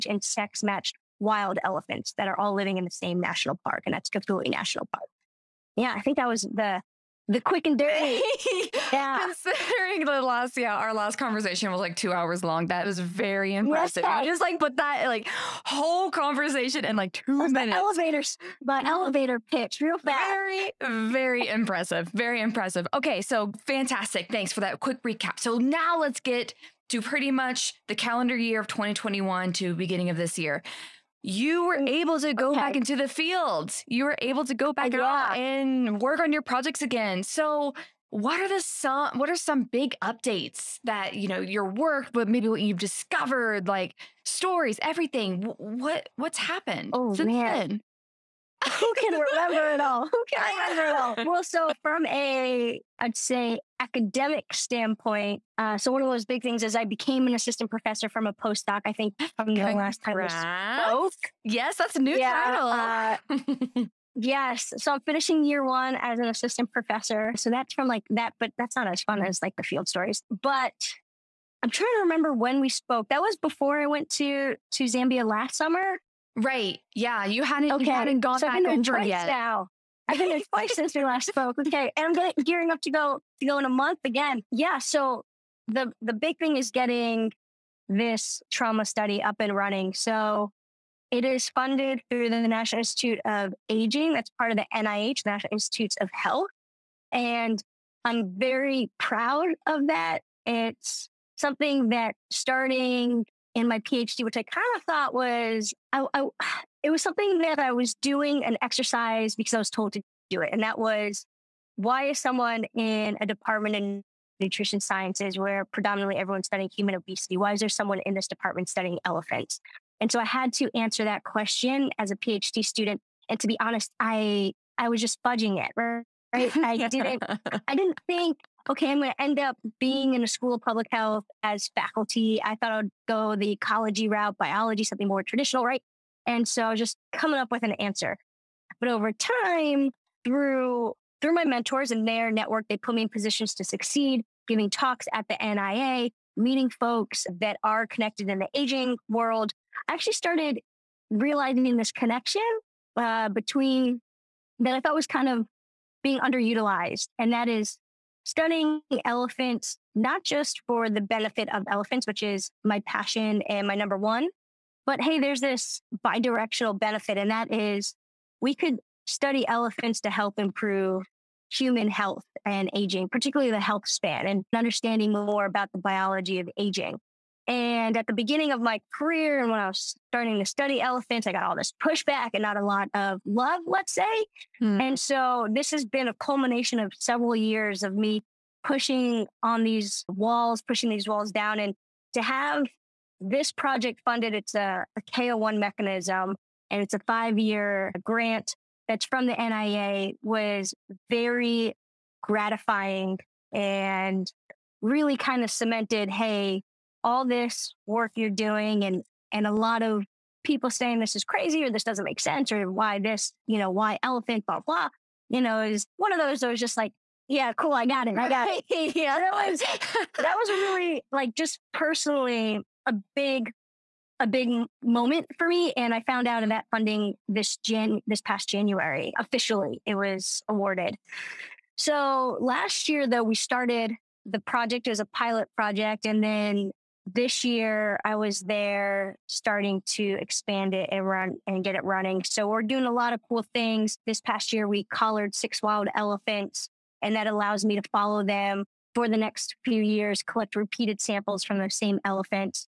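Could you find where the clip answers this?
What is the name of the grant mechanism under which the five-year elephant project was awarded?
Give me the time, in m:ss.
3:15.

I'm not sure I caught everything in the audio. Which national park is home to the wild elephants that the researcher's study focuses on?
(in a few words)
Kafue National Park.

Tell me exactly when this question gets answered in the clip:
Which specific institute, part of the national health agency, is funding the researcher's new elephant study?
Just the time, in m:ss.
1:32.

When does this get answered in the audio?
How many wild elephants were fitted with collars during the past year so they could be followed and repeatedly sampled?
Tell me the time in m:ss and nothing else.
4:05.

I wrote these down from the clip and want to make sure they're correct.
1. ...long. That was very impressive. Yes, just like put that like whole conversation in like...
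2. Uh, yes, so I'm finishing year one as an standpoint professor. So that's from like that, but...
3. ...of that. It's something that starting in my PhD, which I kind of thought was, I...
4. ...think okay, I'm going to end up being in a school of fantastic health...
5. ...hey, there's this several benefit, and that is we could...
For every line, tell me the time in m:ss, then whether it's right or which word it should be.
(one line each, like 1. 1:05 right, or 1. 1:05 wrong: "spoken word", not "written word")
1. 0:12 right
2. 1:03 wrong: "assistant", not "standpoint"
3. 1:39 right
4. 2:08 wrong: "public", not "fantastic"
5. 2:45 wrong: "bidirectional", not "several".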